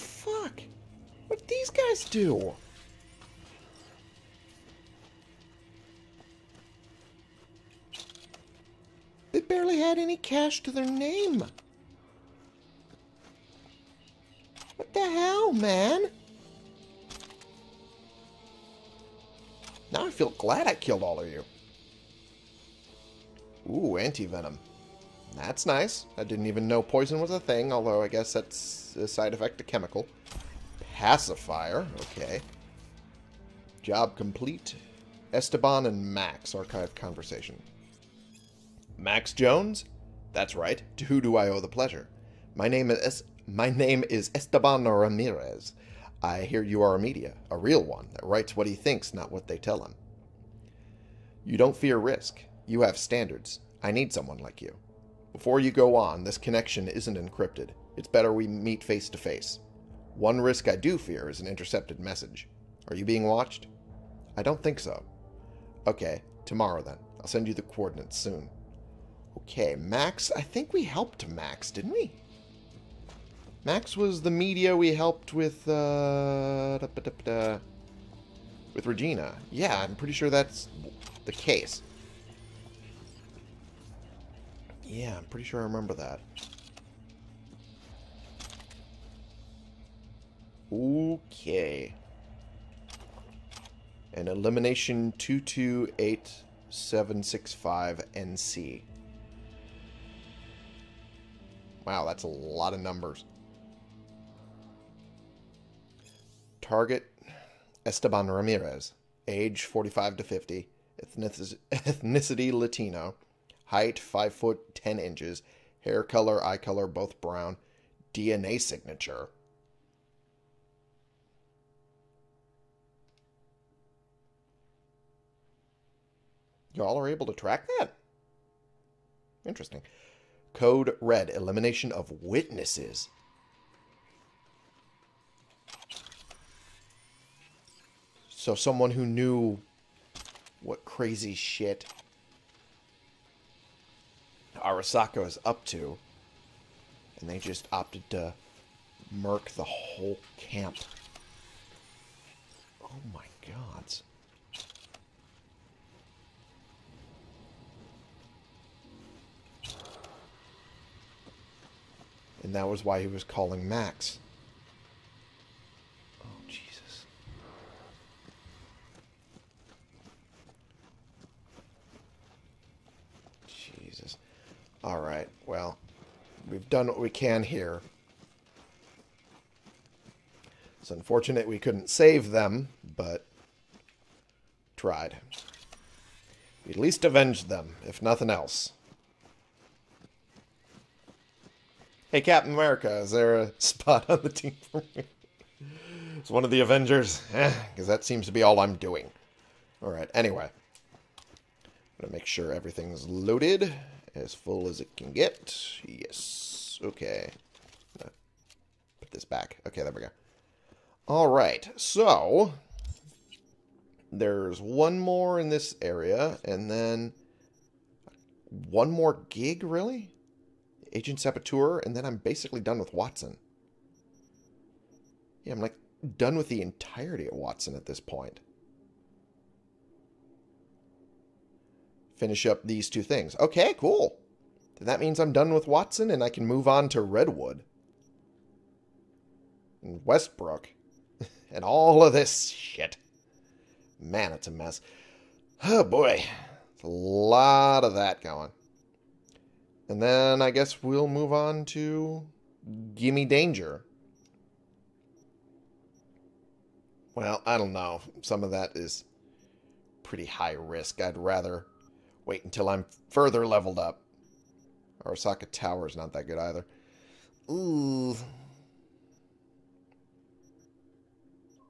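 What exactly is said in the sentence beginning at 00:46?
I hear you are a media, a real one that writes what he thinks, not what they tell him.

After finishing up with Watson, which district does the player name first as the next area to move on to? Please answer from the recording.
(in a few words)
Redwood.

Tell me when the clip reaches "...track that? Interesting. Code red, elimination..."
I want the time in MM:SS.
02:07.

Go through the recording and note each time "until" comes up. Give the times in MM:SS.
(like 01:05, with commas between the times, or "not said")
04:22.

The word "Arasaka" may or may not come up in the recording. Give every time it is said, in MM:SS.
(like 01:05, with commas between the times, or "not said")
02:24, 04:25.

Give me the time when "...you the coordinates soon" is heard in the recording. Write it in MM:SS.
01:07.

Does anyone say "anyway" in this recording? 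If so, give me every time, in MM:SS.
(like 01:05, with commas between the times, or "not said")
03:20.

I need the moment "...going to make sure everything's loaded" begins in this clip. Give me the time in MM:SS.
03:21.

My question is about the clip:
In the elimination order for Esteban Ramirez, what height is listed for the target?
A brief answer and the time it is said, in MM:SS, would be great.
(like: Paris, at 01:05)
5 foot 10 inches, at 01:53.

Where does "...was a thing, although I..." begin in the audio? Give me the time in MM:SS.
00:27.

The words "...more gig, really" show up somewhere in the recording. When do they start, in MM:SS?
03:38.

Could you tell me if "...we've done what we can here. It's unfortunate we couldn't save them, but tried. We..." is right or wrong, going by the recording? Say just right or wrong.
right.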